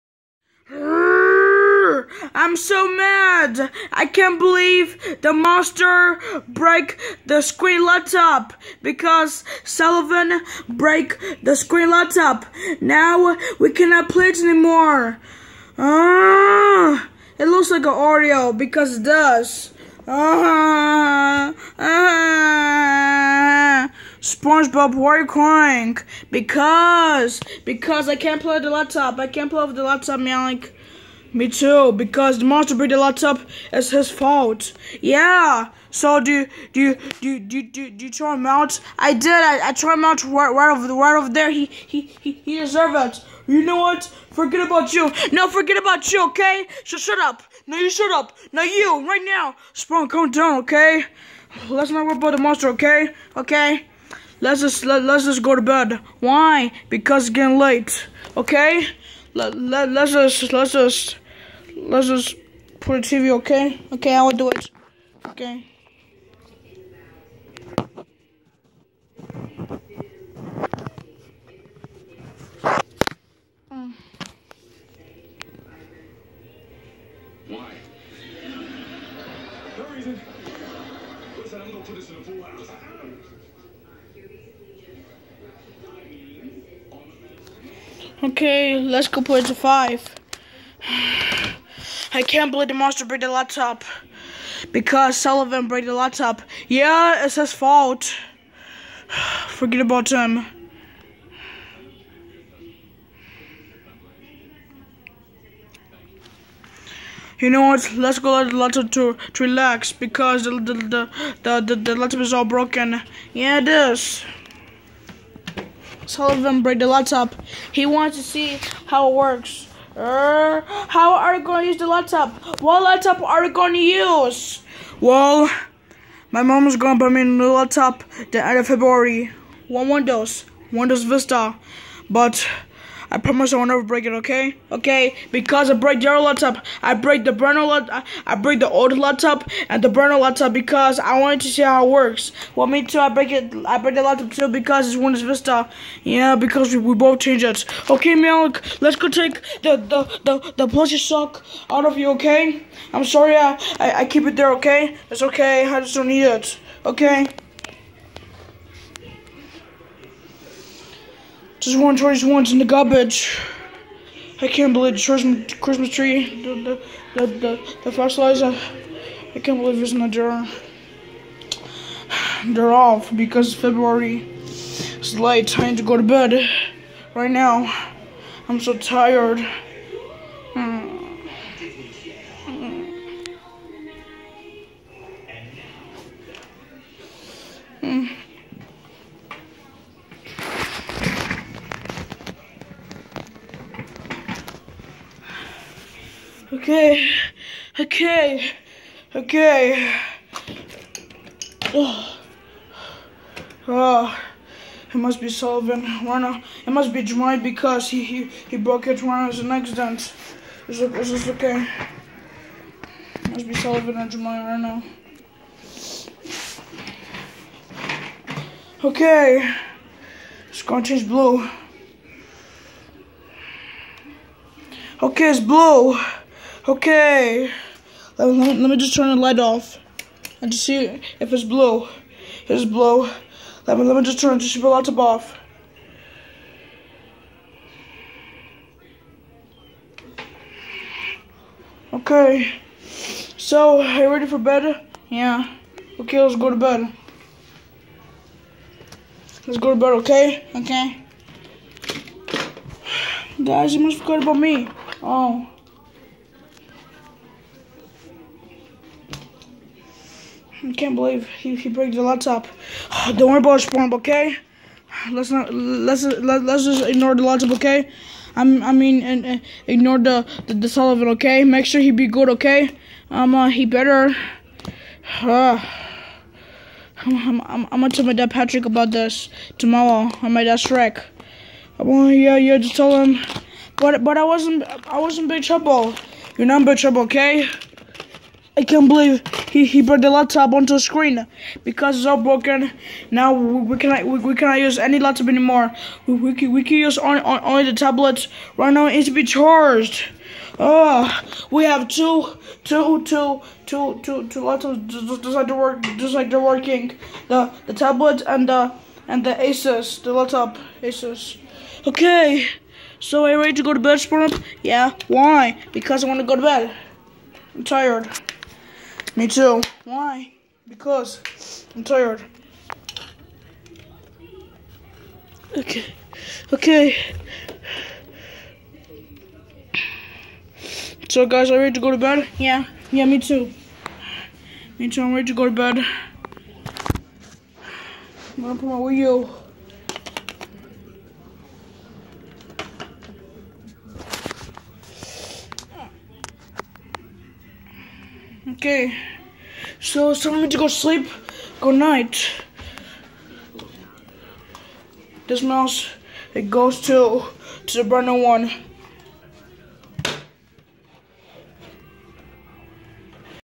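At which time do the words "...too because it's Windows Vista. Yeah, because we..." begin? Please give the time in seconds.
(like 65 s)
144 s.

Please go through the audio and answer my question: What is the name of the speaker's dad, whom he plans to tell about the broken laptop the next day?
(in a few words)
Patrick.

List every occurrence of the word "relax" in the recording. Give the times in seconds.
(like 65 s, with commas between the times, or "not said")
109 s.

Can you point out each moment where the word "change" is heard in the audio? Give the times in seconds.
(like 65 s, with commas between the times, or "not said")
147 s, 220 s.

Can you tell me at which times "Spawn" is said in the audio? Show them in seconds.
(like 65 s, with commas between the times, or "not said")
49 s, 263 s.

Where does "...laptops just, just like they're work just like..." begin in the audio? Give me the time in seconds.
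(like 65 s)
304 s.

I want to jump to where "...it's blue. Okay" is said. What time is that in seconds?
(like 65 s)
225 s.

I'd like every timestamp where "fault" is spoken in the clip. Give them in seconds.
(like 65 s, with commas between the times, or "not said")
34 s, 97 s.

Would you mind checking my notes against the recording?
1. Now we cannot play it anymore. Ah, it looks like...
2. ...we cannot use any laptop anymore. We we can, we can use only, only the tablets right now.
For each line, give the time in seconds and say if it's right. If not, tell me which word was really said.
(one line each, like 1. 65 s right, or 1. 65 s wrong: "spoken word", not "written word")
1. 12 s right
2. 294 s right.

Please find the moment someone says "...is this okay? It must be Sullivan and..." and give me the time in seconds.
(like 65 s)
210 s.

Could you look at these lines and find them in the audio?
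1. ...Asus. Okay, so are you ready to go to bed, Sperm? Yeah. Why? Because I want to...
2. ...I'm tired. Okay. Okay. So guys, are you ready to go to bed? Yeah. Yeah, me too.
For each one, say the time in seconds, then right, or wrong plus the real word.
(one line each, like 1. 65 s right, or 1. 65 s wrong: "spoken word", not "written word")
1. 310 s right
2. 321 s right.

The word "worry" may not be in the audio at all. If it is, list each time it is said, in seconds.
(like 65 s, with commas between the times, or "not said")
52 s, 263 s.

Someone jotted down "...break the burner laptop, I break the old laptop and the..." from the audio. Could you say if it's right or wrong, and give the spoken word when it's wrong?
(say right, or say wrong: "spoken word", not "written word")
right.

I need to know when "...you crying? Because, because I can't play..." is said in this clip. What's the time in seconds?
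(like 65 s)
25 s.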